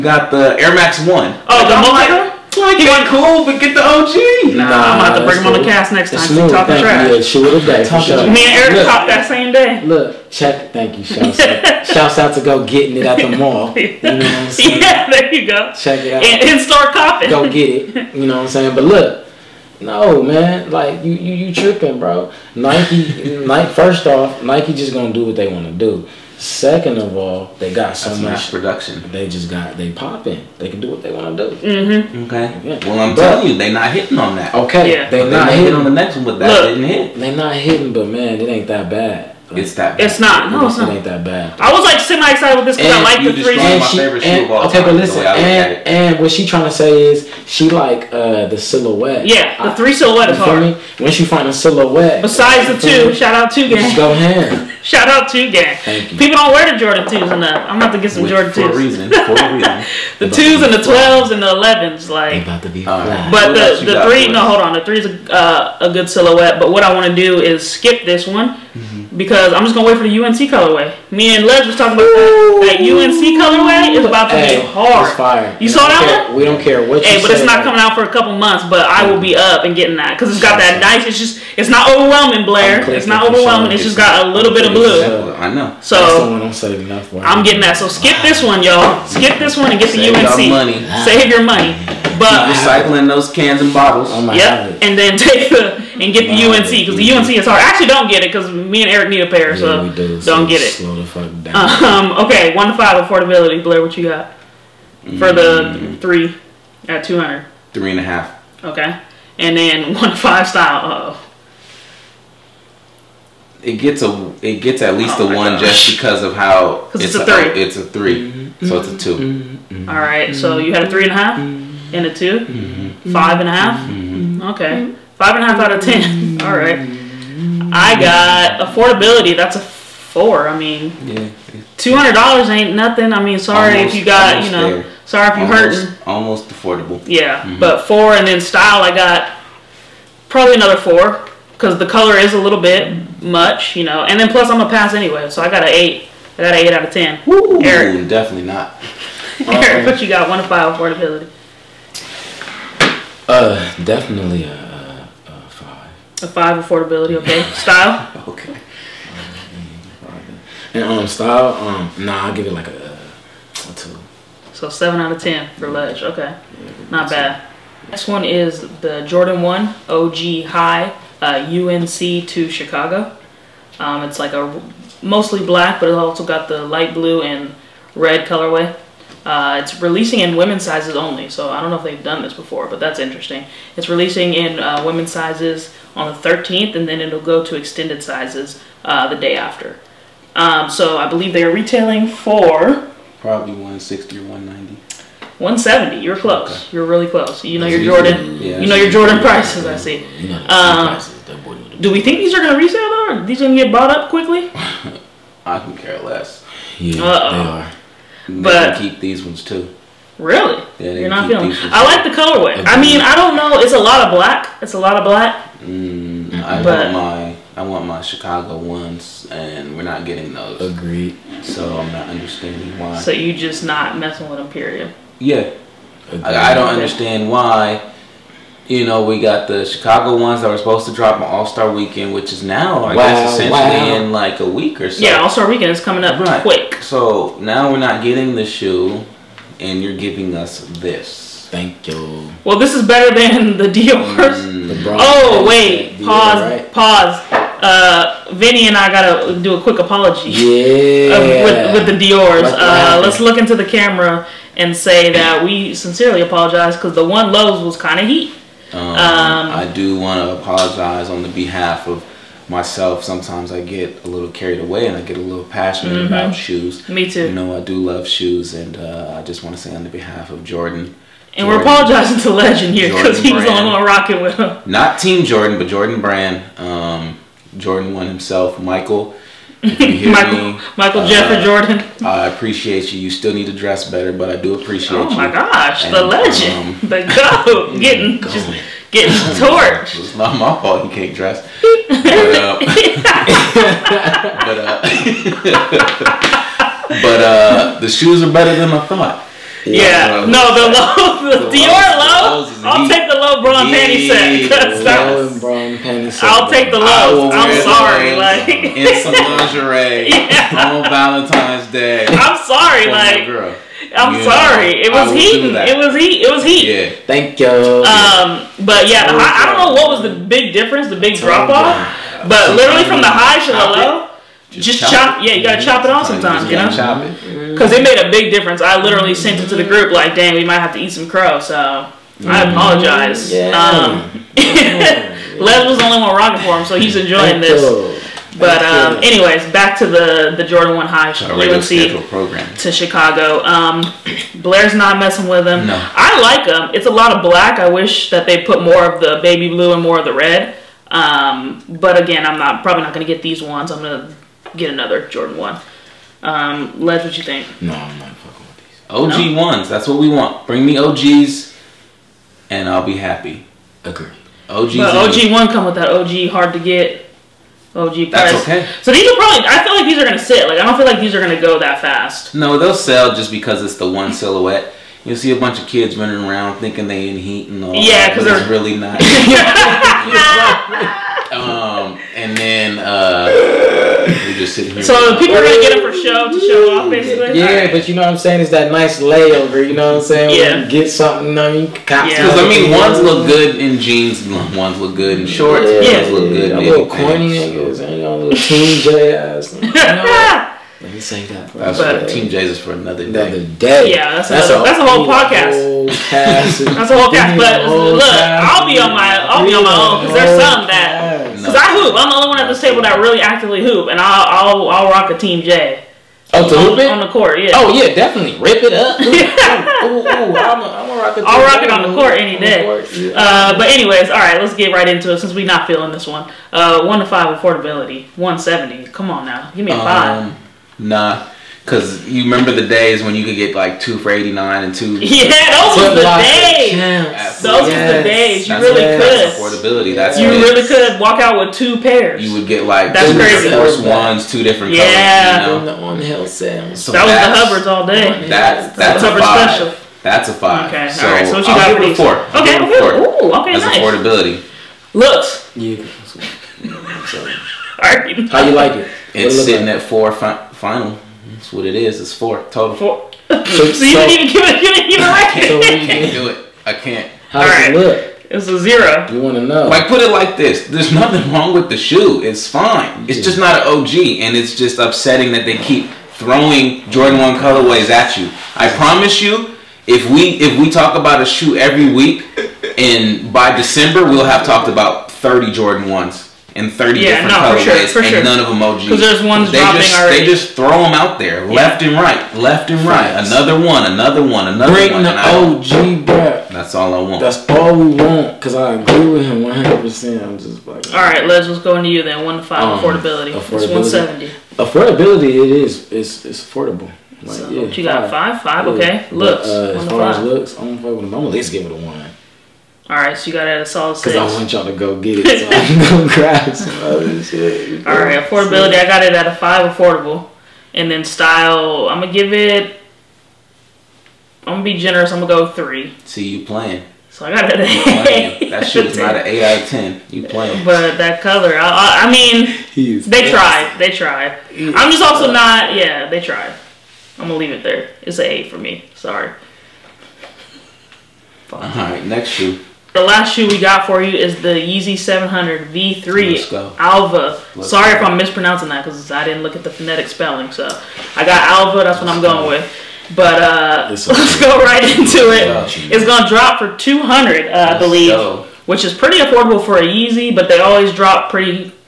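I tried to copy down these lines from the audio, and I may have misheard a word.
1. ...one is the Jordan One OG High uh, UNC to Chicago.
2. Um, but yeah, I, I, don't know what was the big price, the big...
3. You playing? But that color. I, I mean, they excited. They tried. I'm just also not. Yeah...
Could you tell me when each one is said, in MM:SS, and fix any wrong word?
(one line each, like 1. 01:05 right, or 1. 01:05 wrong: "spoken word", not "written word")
1. 02:48 right
2. 05:17 wrong: "difference", not "price"
3. 08:50 wrong: "tried", not "excited".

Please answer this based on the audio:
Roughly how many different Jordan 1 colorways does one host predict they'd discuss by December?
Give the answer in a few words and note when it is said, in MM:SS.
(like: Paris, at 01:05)
30, at 08:05.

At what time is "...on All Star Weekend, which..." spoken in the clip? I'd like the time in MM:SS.
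03:51.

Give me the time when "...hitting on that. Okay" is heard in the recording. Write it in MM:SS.
00:33.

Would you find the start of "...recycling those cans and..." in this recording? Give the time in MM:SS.
01:32.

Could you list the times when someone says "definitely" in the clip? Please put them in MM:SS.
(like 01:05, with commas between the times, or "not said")
02:28, 02:33, 06:57.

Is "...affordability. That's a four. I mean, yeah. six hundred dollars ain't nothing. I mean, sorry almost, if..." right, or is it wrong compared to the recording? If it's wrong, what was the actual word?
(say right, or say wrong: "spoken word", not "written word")
wrong: "two", not "six".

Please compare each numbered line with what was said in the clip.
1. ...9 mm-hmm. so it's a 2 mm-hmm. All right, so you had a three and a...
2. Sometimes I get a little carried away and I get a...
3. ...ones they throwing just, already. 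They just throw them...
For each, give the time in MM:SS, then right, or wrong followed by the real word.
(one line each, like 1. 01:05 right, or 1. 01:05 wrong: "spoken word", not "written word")
1. 01:57 wrong: "3", not "9"
2. 04:23 right
3. 08:09 wrong: "dropping", not "throwing".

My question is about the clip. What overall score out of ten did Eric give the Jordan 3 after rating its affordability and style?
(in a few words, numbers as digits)
7.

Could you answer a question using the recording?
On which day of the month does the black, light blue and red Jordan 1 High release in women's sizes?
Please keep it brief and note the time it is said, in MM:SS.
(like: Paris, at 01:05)
13th, at 03:06.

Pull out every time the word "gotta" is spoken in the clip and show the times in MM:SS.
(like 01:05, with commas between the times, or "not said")
04:08, 05:25.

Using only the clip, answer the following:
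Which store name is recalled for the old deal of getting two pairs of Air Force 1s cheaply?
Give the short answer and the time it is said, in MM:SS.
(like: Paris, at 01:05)
Hubbards, at 07:27.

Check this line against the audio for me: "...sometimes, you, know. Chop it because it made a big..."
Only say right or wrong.
right.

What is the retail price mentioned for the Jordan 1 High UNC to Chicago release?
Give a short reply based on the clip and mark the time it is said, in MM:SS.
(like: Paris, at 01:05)
$170, at 03:15.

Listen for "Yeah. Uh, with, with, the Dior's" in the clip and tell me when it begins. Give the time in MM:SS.
04:10.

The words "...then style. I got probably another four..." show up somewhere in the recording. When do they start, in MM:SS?
02:18.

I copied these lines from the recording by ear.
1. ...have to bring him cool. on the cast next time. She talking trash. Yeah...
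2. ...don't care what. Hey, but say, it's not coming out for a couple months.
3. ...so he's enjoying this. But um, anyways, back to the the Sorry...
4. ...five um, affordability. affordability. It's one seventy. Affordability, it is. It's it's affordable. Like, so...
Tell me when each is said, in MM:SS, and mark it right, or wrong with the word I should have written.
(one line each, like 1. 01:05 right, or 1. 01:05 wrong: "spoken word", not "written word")
1. 00:05 right
2. 01:16 right
3. 05:36 wrong: "Jordan", not "Sorry"
4. 08:22 right.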